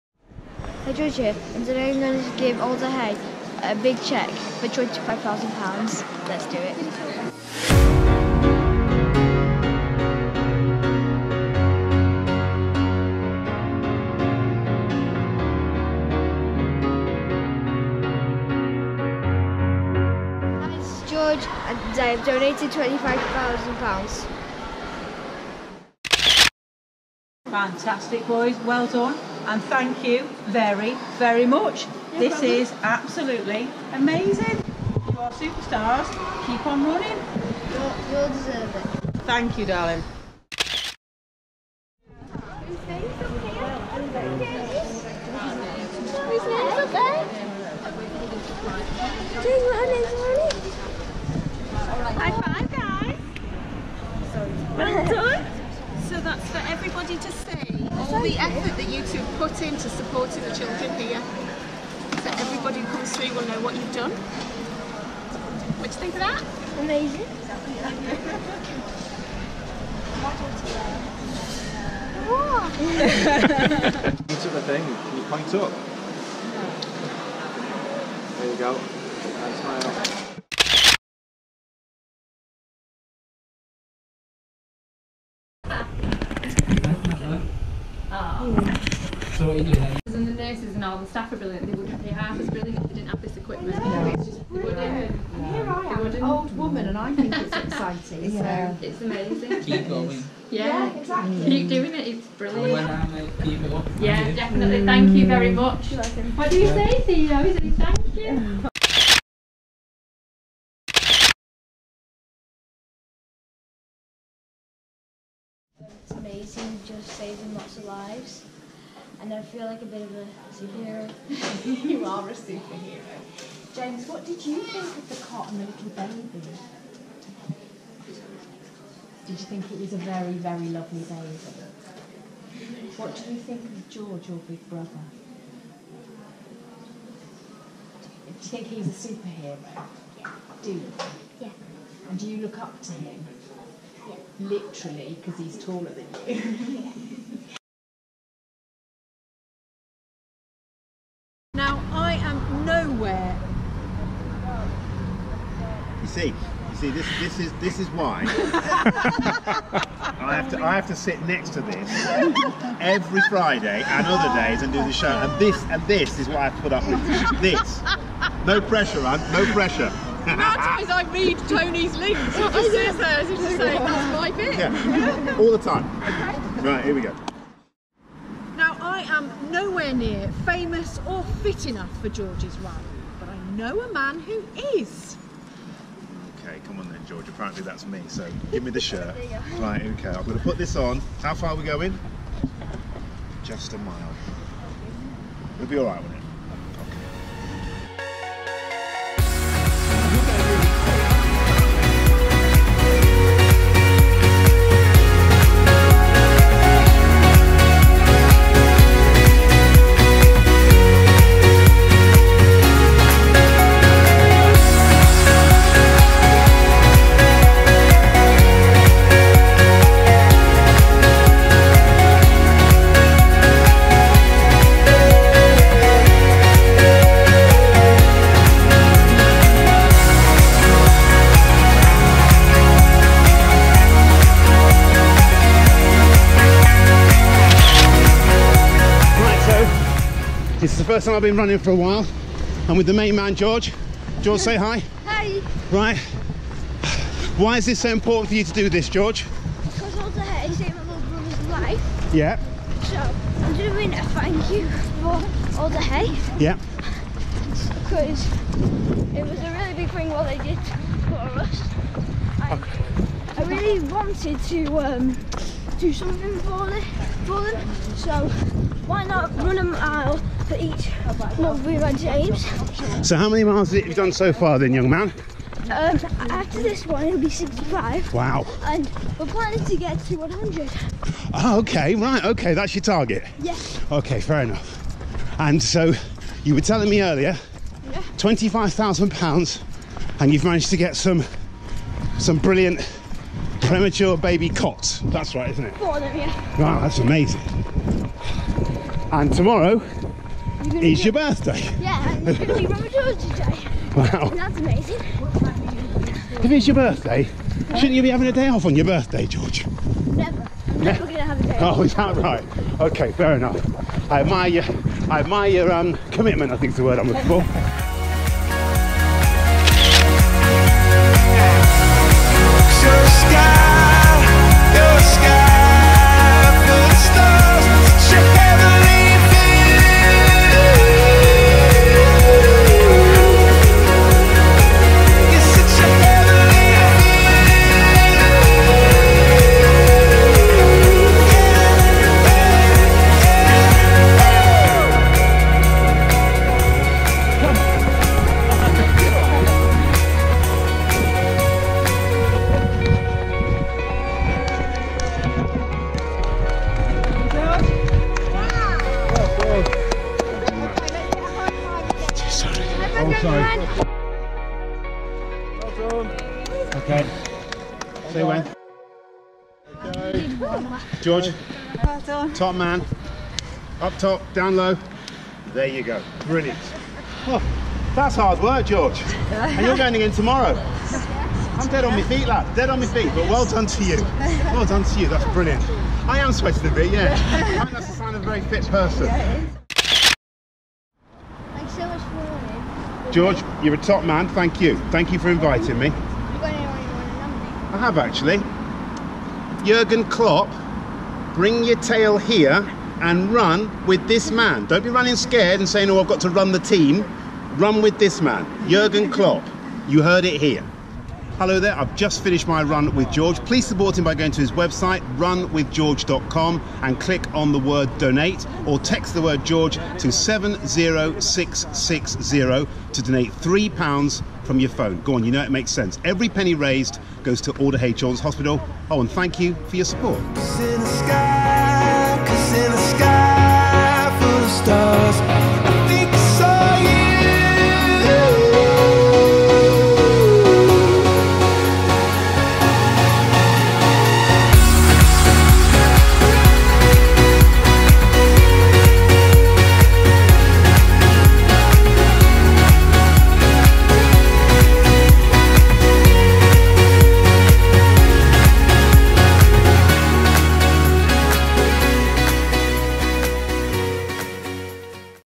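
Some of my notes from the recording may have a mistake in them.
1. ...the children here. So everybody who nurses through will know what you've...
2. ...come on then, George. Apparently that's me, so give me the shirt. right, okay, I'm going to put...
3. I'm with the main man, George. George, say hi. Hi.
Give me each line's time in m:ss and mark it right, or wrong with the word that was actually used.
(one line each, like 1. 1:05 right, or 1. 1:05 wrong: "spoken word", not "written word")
1. 1:00 wrong: "comes", not "nurses"
2. 3:06 right
3. 4:02 right.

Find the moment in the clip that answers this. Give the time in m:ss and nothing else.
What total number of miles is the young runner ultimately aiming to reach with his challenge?
4:40.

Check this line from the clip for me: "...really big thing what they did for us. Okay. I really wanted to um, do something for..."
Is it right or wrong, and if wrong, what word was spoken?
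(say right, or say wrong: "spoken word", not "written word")
right.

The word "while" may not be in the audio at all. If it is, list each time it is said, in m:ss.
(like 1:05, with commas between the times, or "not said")
4:01.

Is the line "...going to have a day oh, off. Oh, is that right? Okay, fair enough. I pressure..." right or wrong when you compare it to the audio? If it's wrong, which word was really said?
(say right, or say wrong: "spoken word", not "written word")
wrong: "admire", not "pressure".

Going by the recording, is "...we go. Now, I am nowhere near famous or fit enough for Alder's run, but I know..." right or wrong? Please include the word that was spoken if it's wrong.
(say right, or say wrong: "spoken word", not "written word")
wrong: "George", not "Alder".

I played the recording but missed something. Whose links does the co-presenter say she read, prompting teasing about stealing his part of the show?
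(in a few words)
Tony.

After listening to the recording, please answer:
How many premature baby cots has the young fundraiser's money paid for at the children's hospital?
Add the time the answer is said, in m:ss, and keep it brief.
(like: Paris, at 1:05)
4, at 4:55.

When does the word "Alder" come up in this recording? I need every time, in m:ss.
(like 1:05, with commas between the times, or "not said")
0:02, 4:09, 4:15, 7:07.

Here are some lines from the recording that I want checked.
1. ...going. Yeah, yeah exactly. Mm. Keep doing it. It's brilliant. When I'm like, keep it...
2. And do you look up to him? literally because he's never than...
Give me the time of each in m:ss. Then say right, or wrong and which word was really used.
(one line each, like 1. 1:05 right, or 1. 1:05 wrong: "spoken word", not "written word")
1. 1:39 right
2. 2:22 wrong: "taller", not "never".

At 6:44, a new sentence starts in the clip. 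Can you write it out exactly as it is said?
Don't be running scared and saying, oh, I've got to run the team.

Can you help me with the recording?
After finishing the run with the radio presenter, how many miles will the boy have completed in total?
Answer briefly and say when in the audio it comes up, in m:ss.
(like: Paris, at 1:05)
65, at 4:37.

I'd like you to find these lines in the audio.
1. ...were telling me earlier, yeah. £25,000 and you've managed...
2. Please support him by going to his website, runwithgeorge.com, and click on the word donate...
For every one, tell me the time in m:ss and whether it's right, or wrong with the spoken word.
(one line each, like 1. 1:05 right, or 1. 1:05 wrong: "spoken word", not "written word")
1. 4:46 right
2. 6:53 right.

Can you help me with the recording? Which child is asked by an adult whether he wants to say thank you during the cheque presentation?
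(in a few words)
Theo.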